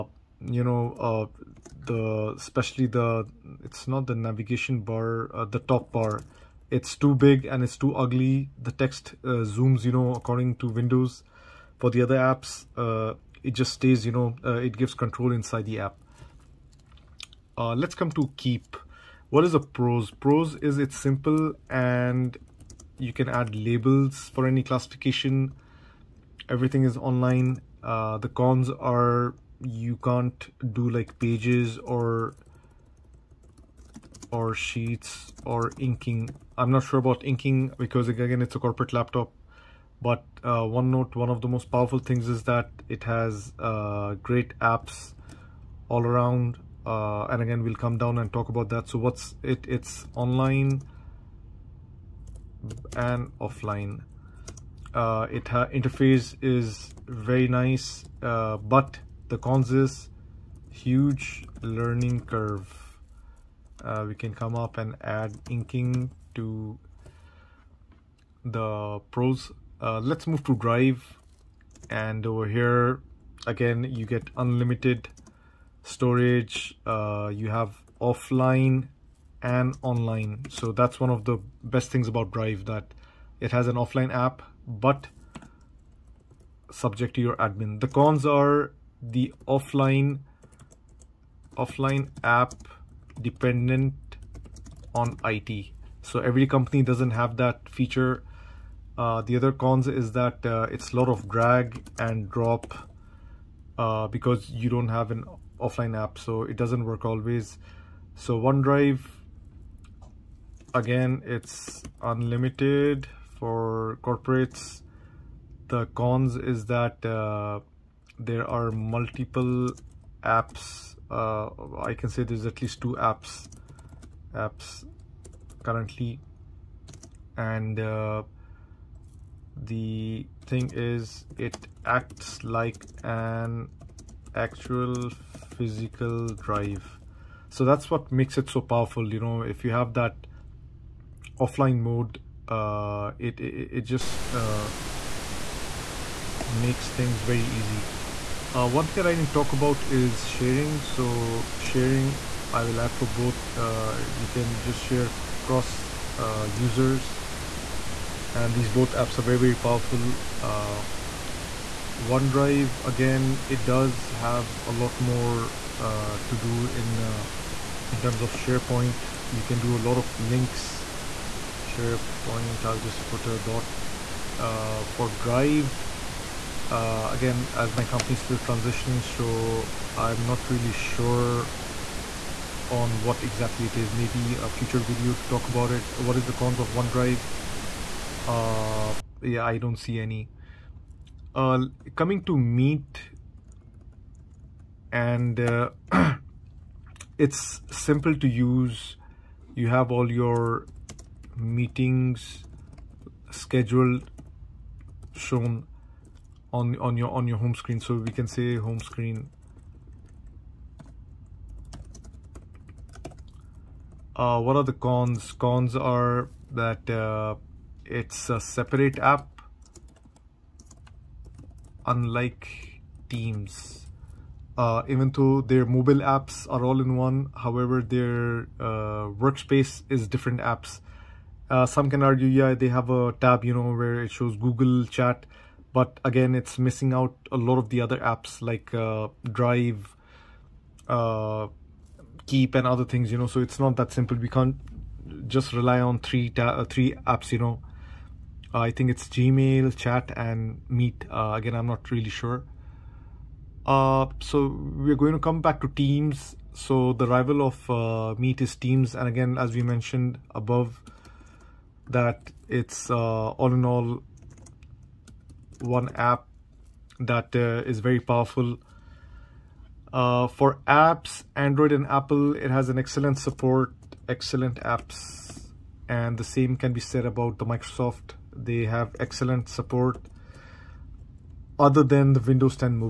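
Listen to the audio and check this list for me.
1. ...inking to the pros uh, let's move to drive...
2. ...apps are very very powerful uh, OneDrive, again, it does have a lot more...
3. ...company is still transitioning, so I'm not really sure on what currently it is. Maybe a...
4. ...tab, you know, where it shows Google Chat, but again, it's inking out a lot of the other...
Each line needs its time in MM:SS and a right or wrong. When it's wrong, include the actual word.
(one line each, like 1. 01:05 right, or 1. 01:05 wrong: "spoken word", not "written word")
1. 01:05 right
2. 02:38 right
3. 02:57 wrong: "exactly", not "currently"
4. 03:53 wrong: "missing", not "inking".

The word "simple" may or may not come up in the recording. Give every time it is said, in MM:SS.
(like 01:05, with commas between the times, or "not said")
00:20, 03:17, 04:03.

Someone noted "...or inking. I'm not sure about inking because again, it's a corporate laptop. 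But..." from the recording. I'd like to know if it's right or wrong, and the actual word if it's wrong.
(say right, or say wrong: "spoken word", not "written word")
right.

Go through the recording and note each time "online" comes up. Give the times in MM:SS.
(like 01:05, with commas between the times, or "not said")
00:26, 00:50, 01:19.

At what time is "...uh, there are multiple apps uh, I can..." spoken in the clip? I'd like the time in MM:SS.
01:57.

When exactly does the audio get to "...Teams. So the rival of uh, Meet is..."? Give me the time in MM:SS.
04:15.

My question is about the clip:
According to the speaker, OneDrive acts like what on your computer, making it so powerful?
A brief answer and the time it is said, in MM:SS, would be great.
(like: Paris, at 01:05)
an actual physical drive, at 02:13.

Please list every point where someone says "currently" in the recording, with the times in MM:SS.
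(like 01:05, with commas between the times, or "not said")
02:05.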